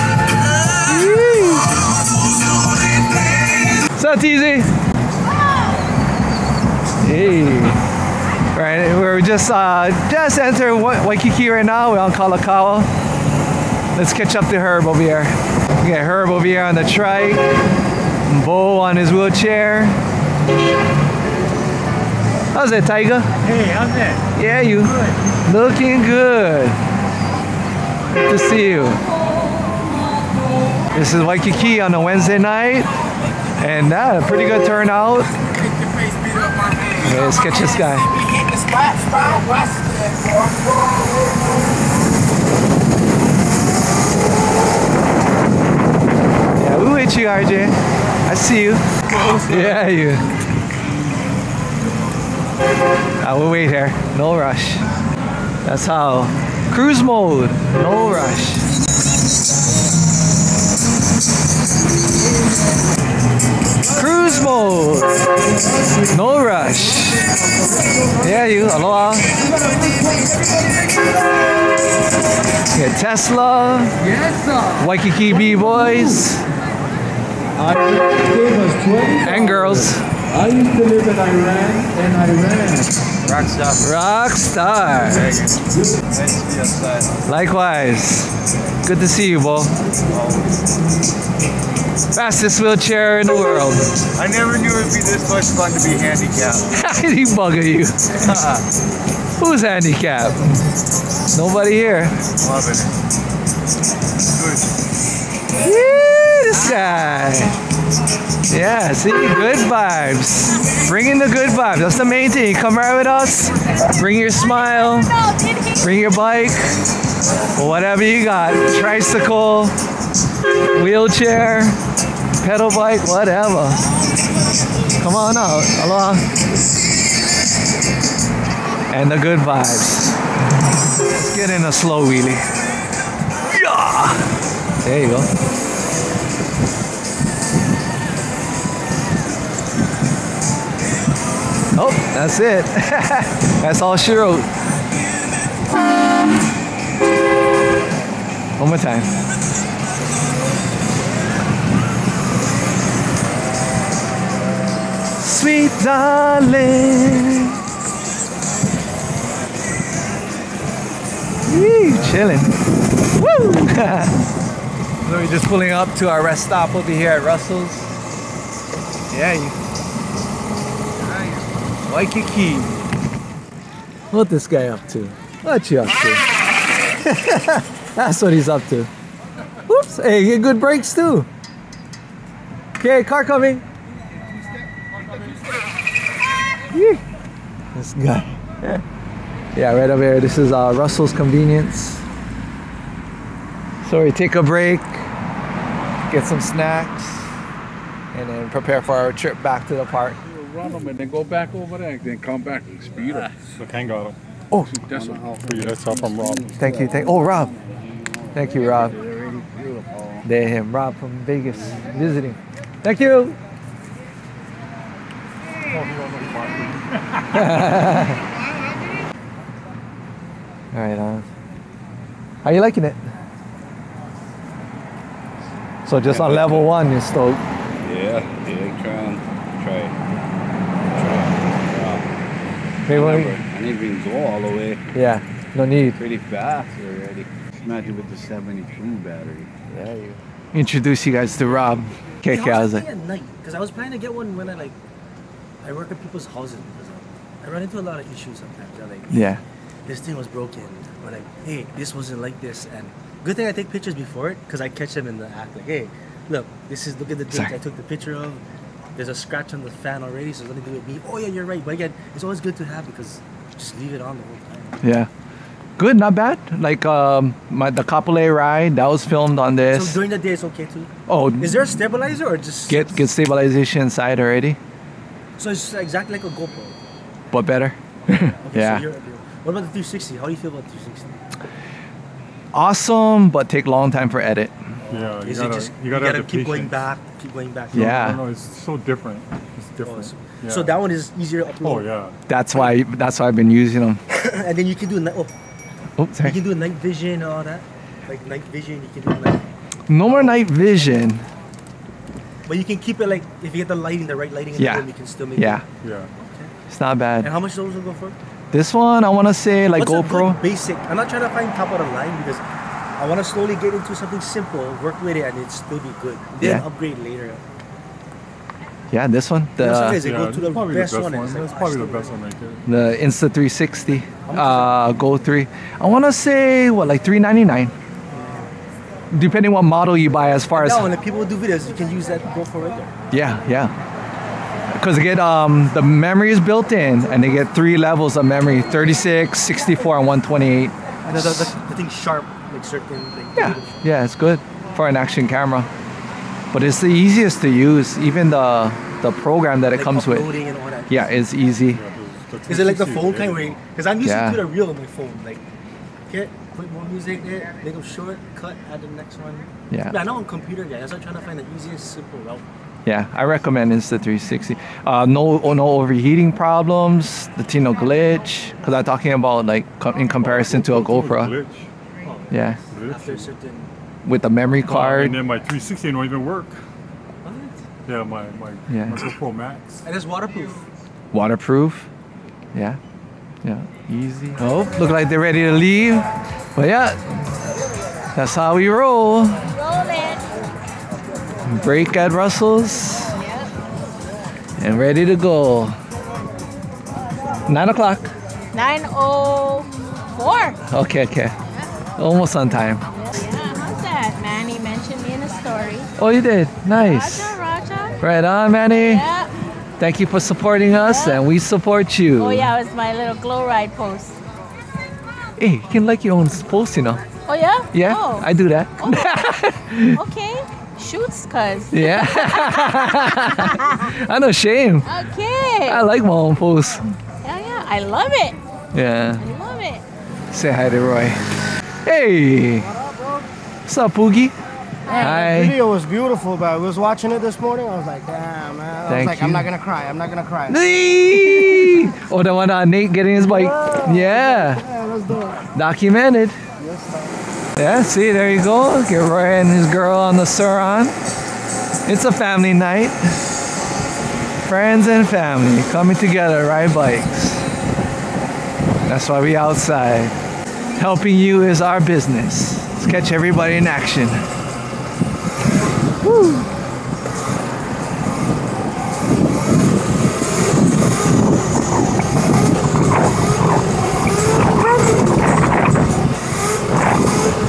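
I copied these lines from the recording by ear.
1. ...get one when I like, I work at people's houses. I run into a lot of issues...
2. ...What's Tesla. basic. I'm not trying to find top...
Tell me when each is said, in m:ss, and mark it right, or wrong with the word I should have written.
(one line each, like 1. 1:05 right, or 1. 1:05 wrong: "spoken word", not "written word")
1. 4:03 right
2. 5:09 wrong: "GoPro", not "Tesla".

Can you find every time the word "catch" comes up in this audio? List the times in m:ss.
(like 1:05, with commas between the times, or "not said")
0:14, 0:37, 4:14, 7:42.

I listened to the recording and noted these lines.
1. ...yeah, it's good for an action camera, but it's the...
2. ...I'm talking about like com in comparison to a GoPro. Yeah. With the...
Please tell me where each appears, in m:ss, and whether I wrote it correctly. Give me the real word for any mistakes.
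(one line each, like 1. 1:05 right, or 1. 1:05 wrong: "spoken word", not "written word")
1. 5:43 right
2. 6:08 right.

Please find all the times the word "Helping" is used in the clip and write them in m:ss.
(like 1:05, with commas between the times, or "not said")
7:40.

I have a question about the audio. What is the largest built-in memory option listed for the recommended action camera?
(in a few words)
128.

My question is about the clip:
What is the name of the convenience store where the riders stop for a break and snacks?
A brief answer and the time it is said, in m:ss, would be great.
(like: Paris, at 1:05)
Russell's Convenience, at 3:10.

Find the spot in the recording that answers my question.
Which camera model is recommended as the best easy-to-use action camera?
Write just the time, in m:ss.
5:22.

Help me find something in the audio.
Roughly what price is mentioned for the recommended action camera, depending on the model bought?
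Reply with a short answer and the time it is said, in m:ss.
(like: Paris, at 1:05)
399, at 5:27.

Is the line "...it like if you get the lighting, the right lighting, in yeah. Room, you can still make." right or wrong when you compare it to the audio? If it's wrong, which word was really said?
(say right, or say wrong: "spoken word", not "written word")
right.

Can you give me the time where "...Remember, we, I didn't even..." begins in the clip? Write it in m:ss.
3:53.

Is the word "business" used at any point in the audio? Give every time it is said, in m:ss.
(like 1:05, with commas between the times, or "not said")
7:41.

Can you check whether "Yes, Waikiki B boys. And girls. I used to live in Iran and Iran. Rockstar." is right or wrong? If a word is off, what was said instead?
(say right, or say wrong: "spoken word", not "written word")
right.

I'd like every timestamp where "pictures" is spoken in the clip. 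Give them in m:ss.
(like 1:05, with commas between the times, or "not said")
4:13, 4:17.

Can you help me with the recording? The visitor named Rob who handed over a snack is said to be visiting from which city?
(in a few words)
Vegas.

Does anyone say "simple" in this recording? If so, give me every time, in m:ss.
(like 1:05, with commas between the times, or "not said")
5:14, 6:01.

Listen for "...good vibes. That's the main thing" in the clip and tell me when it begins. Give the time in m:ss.
1:51.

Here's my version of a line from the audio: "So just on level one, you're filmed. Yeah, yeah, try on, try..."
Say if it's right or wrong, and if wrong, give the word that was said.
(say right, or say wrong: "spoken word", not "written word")
wrong: "stoked", not "filmed".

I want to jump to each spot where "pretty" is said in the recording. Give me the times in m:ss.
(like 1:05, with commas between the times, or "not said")
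0:34, 3:55.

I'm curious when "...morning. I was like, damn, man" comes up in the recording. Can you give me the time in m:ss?
7:17.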